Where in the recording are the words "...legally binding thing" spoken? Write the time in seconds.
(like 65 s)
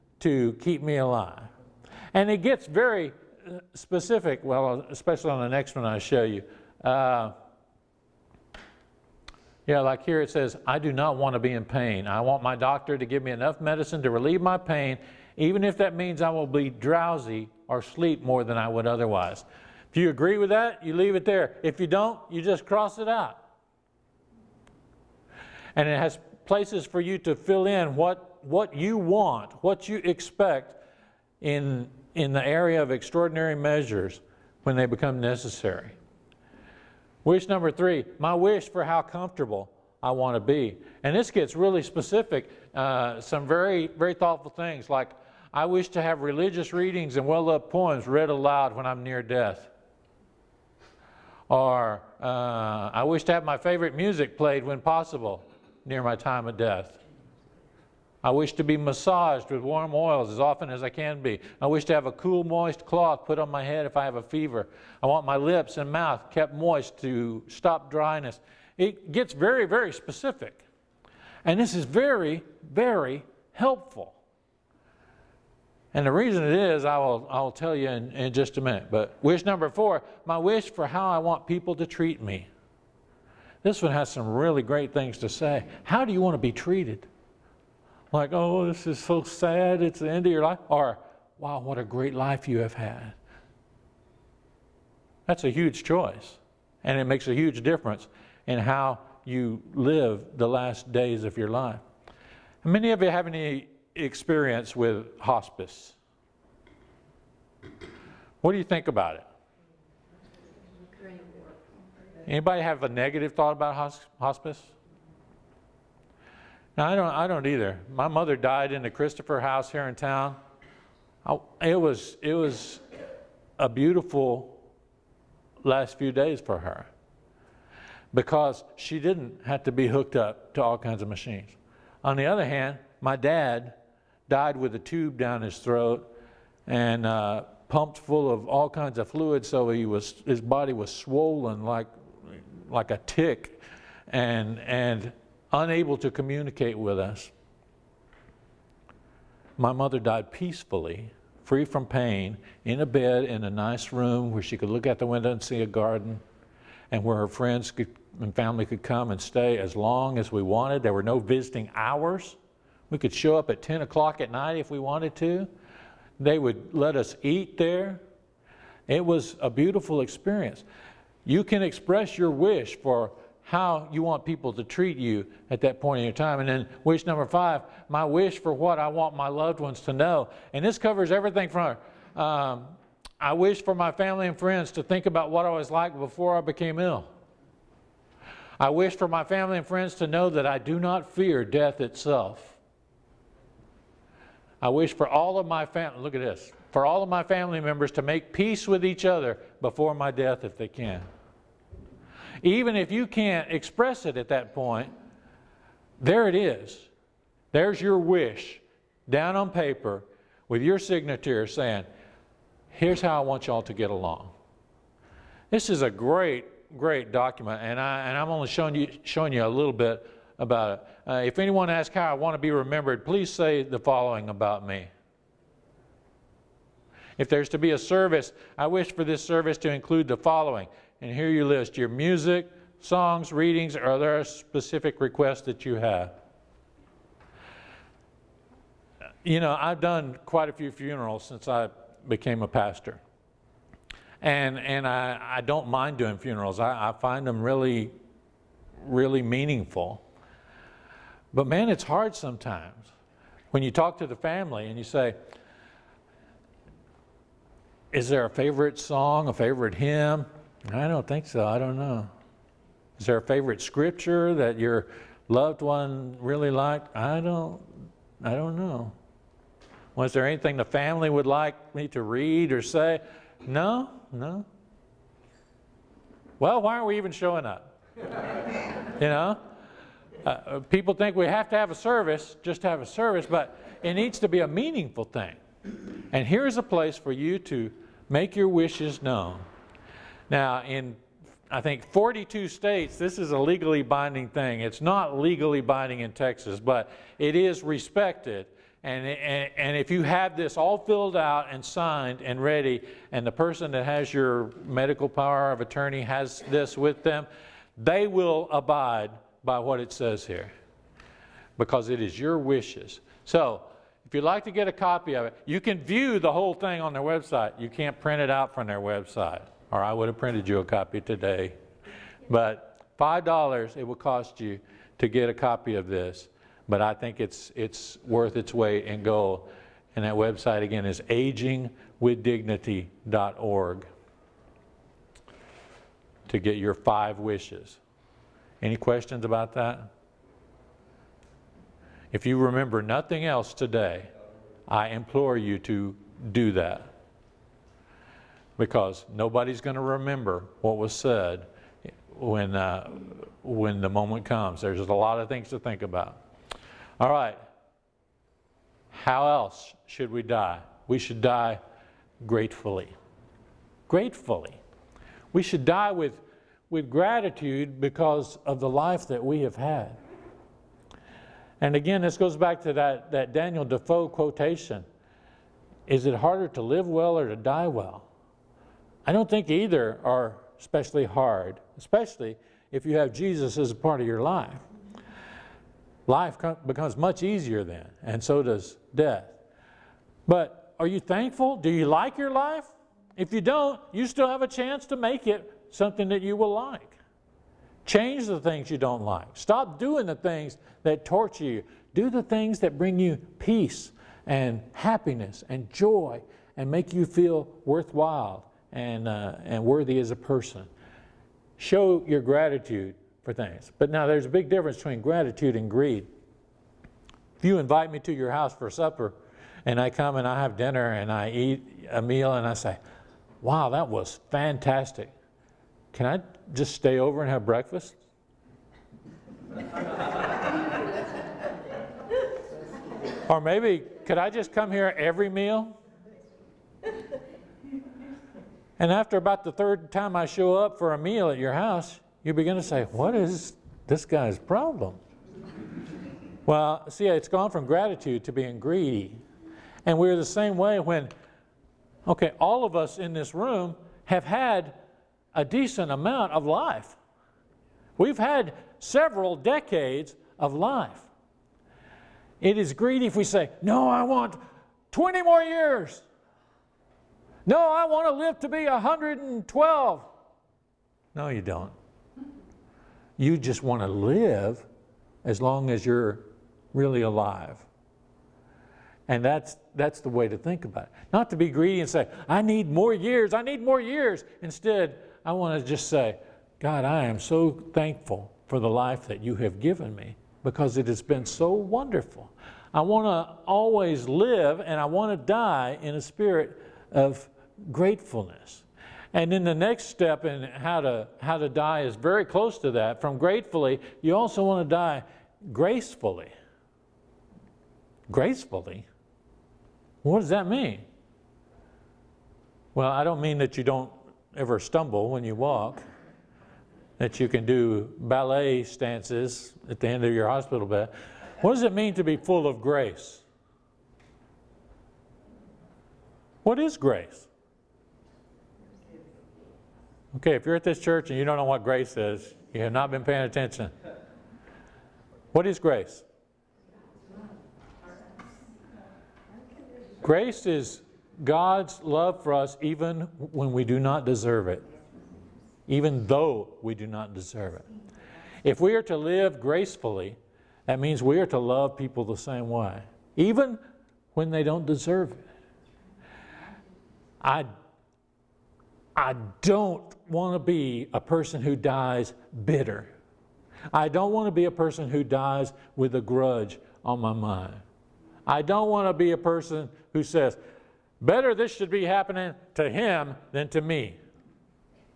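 293 s.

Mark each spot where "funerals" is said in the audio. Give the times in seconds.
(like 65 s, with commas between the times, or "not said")
240 s, 246 s.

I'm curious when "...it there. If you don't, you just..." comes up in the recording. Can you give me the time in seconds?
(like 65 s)
21 s.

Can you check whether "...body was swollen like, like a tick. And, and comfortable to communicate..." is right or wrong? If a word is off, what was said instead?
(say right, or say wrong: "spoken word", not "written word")
wrong: "unable", not "comfortable".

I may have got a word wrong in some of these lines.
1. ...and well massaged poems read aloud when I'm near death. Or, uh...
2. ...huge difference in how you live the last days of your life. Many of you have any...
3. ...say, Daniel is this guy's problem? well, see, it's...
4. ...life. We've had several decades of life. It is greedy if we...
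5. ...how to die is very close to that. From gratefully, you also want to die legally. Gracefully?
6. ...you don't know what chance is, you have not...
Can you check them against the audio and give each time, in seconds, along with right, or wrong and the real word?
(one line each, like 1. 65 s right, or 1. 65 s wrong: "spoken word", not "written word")
1. 47 s wrong: "loved", not "massaged"
2. 97 s right
3. 442 s wrong: "What", not "Daniel"
4. 456 s right
5. 501 s wrong: "gracefully", not "legally"
6. 531 s wrong: "grace", not "chance".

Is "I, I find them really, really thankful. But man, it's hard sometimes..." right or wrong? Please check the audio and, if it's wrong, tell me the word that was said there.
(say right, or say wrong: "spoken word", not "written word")
wrong: "meaningful", not "thankful".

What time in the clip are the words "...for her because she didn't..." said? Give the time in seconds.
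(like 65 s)
126 s.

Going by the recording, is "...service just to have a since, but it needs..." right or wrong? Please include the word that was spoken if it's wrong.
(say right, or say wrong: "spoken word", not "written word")
wrong: "service", not "since".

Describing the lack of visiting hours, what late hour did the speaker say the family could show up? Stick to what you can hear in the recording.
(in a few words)
10 o'clock at night.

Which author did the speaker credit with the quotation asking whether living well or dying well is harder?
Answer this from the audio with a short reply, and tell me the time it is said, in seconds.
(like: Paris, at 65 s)
Daniel Defoe, at 373 s.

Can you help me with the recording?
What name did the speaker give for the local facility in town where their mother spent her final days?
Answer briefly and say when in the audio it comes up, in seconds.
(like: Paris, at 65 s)
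Christopher house, at 118 s.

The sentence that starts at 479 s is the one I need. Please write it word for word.
And that's, that's the way to think about it.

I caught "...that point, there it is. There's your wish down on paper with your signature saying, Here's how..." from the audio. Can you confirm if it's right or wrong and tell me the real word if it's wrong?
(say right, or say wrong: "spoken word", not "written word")
right.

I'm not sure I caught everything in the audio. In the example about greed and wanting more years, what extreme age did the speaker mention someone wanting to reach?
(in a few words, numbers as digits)
112.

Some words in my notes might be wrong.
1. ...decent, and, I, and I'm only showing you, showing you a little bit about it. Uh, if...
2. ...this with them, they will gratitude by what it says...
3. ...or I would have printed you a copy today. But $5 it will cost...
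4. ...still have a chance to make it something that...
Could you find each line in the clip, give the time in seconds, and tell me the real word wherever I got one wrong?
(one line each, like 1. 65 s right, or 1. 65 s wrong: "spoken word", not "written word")
1. 217 s wrong: "document", not "decent"
2. 306 s wrong: "abide", not "gratitude"
3. 319 s right
4. 394 s right.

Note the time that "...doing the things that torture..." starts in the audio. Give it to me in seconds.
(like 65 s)
399 s.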